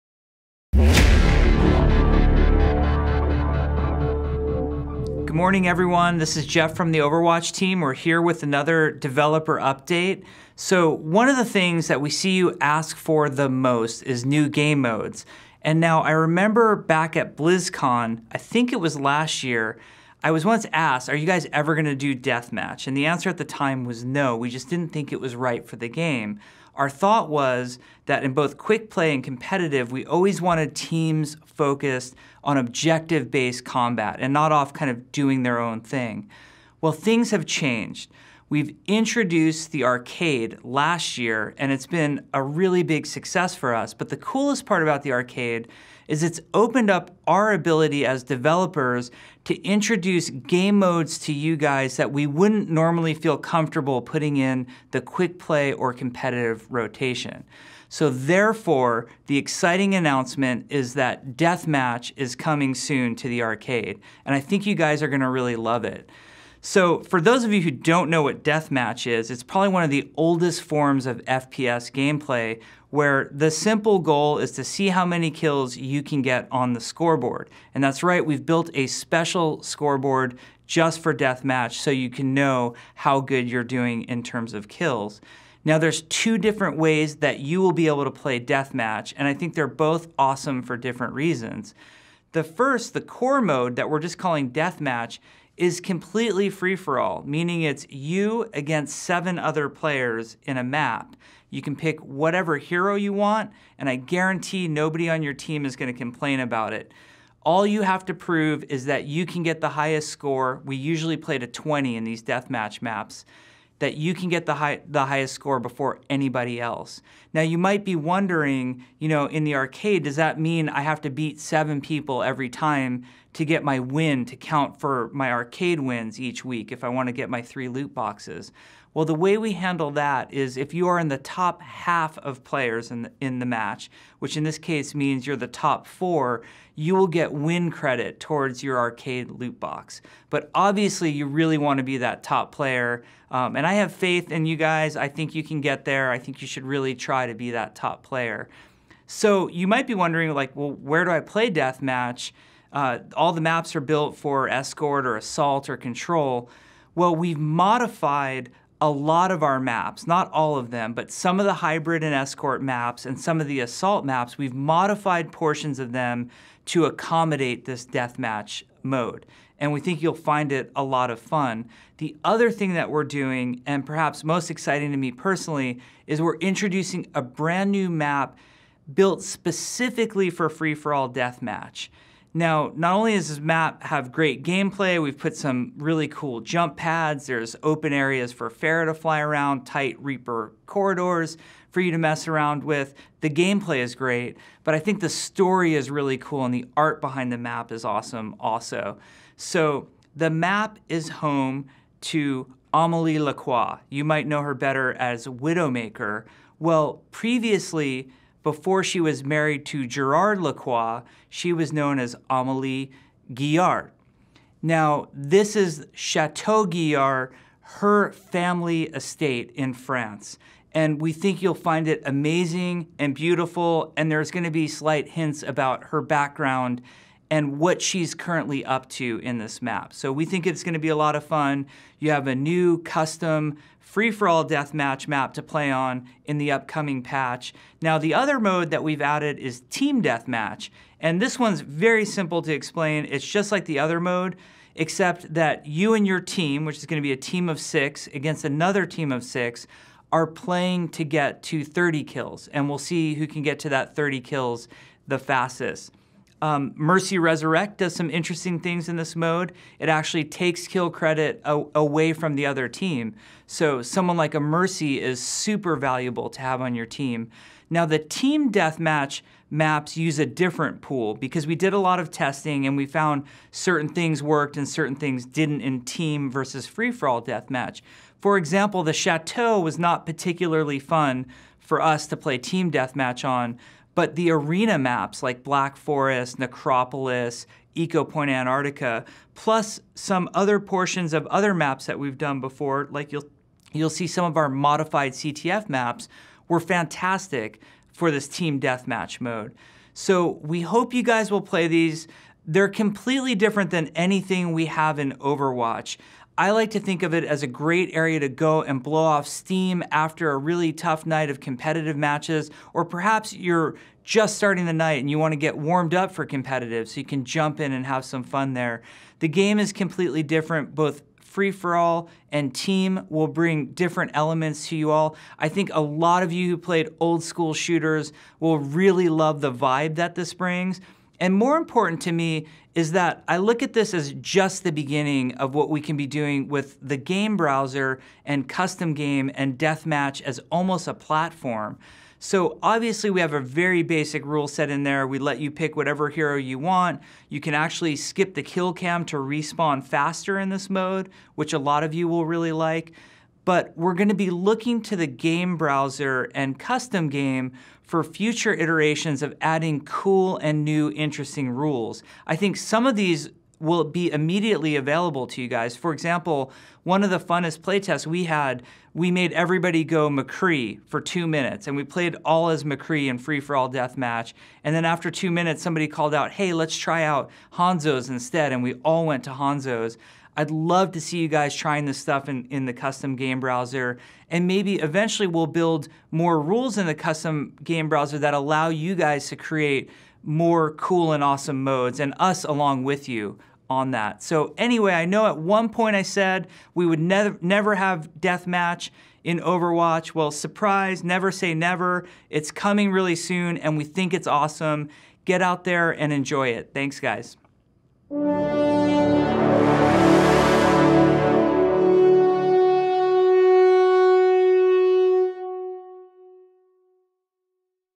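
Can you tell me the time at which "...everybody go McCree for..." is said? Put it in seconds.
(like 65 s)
369 s.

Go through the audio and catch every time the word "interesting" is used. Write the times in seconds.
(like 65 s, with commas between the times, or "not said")
258 s, 360 s.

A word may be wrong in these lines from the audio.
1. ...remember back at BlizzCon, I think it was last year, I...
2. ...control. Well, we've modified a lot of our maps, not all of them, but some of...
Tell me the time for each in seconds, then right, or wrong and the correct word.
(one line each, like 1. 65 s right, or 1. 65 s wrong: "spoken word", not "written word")
1. 16 s right
2. 155 s right.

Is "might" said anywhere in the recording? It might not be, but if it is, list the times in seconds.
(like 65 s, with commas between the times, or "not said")
117 s, 149 s, 204 s.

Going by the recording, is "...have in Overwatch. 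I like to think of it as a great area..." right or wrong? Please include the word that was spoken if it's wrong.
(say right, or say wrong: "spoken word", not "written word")
right.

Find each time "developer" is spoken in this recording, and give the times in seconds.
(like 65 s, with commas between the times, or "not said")
8 s, 48 s.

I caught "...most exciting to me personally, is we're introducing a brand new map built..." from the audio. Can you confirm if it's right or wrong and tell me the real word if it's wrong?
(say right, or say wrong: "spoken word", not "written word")
right.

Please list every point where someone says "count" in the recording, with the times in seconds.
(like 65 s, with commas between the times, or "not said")
124 s.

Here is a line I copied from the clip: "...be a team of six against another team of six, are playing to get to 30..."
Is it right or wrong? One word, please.
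right.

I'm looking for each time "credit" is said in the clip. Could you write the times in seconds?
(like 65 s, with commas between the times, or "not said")
137 s, 260 s.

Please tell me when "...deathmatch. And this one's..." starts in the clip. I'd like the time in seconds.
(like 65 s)
240 s.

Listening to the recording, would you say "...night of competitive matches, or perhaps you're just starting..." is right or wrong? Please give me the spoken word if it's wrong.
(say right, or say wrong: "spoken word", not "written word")
right.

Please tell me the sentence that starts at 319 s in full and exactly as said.
The game is completely different, both free for all and team will bring different elements to you all.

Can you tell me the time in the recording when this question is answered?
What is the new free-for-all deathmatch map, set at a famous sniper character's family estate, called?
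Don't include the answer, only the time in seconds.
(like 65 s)
215 s.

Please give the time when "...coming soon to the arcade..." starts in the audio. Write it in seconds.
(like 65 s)
62 s.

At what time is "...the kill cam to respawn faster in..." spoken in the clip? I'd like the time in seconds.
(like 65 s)
348 s.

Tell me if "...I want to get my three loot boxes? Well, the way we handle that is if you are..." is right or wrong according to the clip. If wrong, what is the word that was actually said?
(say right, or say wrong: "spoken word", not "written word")
right.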